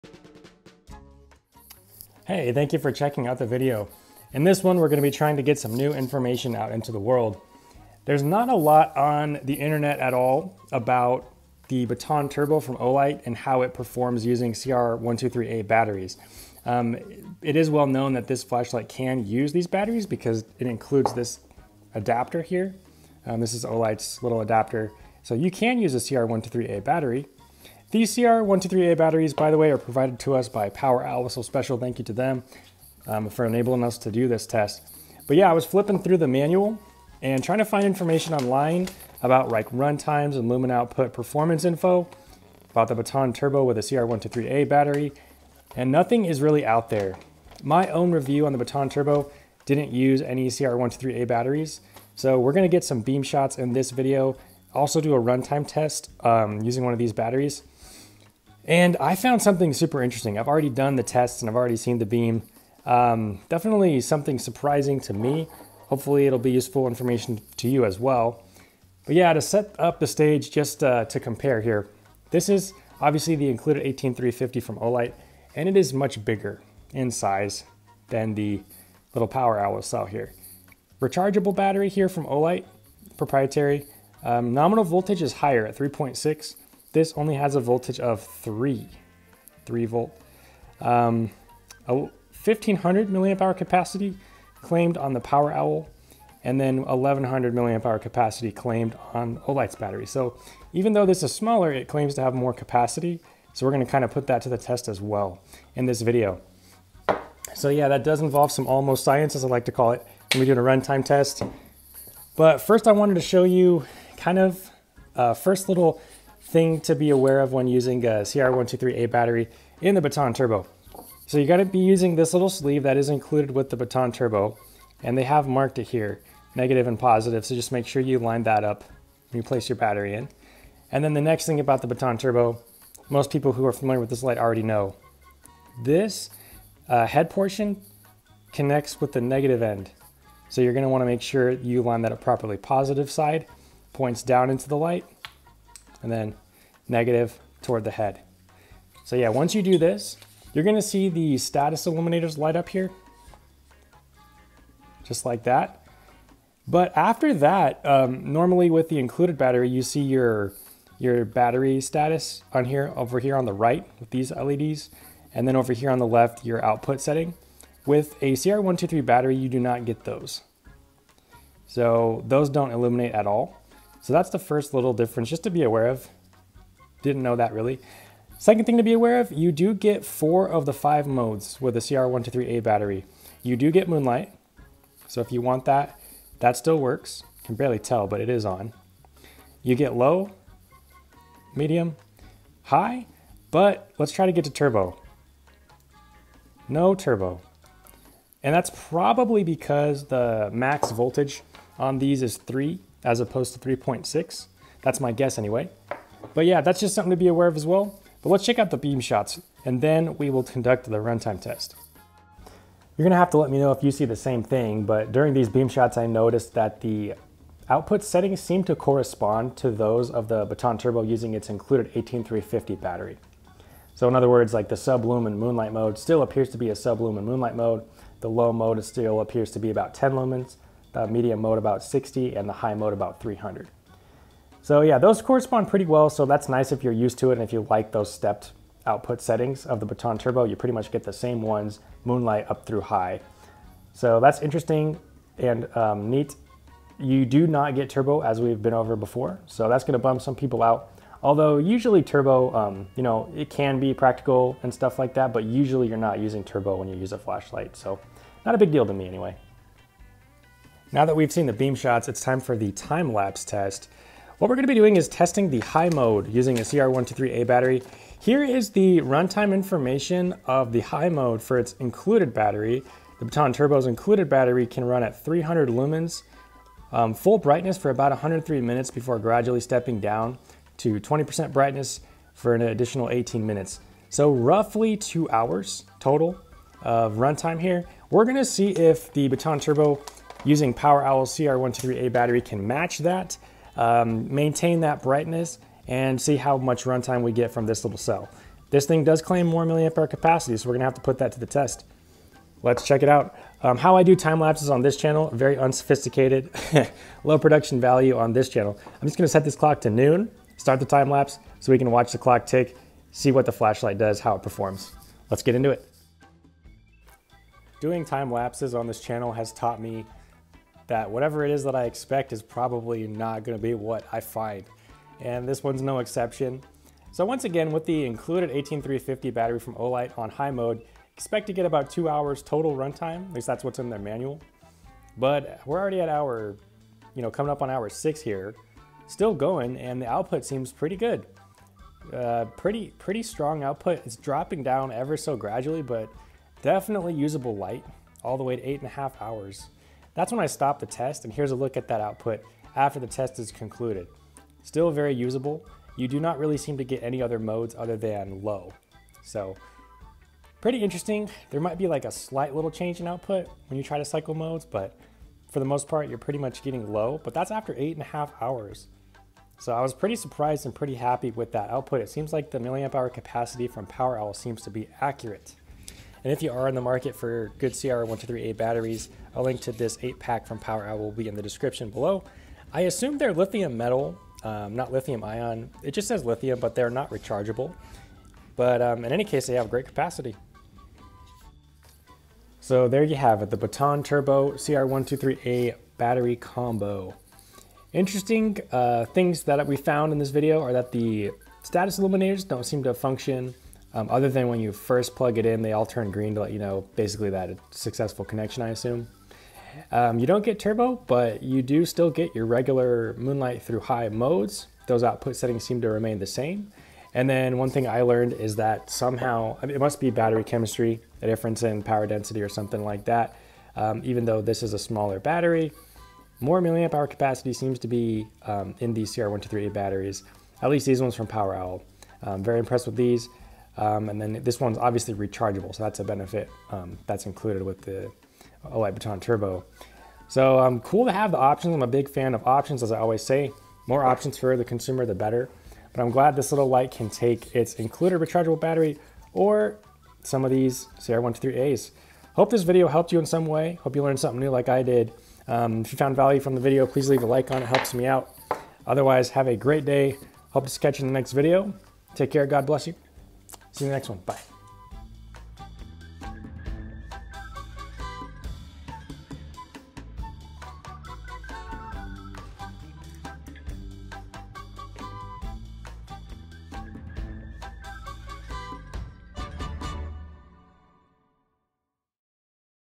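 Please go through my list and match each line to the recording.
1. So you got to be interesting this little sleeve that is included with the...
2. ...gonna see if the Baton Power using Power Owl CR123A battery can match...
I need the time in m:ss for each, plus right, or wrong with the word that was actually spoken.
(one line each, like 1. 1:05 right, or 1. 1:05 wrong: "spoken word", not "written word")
1. 2:01 wrong: "using", not "interesting"
2. 4:48 wrong: "Turbo", not "Power".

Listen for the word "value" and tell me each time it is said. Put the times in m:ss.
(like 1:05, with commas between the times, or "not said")
5:07, 7:36.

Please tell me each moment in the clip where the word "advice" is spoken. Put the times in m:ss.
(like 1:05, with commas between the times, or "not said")
not said.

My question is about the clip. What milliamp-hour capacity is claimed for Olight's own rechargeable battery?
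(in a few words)
1100.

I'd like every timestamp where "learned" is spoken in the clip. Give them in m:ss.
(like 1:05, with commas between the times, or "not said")
6:58, 7:34.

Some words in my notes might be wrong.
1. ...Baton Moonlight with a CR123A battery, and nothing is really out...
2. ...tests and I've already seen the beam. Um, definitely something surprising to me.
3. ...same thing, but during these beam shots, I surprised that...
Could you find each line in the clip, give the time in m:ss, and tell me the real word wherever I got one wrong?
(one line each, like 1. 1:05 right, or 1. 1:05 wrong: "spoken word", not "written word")
1. 0:42 wrong: "Turbo", not "Moonlight"
2. 1:01 right
3. 3:34 wrong: "noticed", not "surprised".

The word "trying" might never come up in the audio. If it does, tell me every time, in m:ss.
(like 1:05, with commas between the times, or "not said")
0:05, 0:37.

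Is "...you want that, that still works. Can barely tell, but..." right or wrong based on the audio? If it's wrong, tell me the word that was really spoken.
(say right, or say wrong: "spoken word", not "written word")
right.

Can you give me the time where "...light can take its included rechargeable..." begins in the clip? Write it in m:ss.
7:26.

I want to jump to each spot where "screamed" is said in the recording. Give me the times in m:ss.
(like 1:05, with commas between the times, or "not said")
not said.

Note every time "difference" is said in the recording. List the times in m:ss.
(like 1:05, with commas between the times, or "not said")
2:54, 7:01.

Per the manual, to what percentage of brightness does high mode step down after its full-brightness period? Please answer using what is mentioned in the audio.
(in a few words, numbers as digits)
20%.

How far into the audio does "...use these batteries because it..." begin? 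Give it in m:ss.
0:19.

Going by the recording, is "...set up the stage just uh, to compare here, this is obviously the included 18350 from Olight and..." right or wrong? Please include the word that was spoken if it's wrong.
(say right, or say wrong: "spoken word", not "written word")
right.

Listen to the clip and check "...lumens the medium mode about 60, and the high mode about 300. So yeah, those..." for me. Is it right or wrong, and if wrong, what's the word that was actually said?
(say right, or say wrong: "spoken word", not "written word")
right.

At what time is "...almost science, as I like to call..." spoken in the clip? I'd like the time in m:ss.
1:48.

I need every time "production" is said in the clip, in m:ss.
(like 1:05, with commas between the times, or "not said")
5:07.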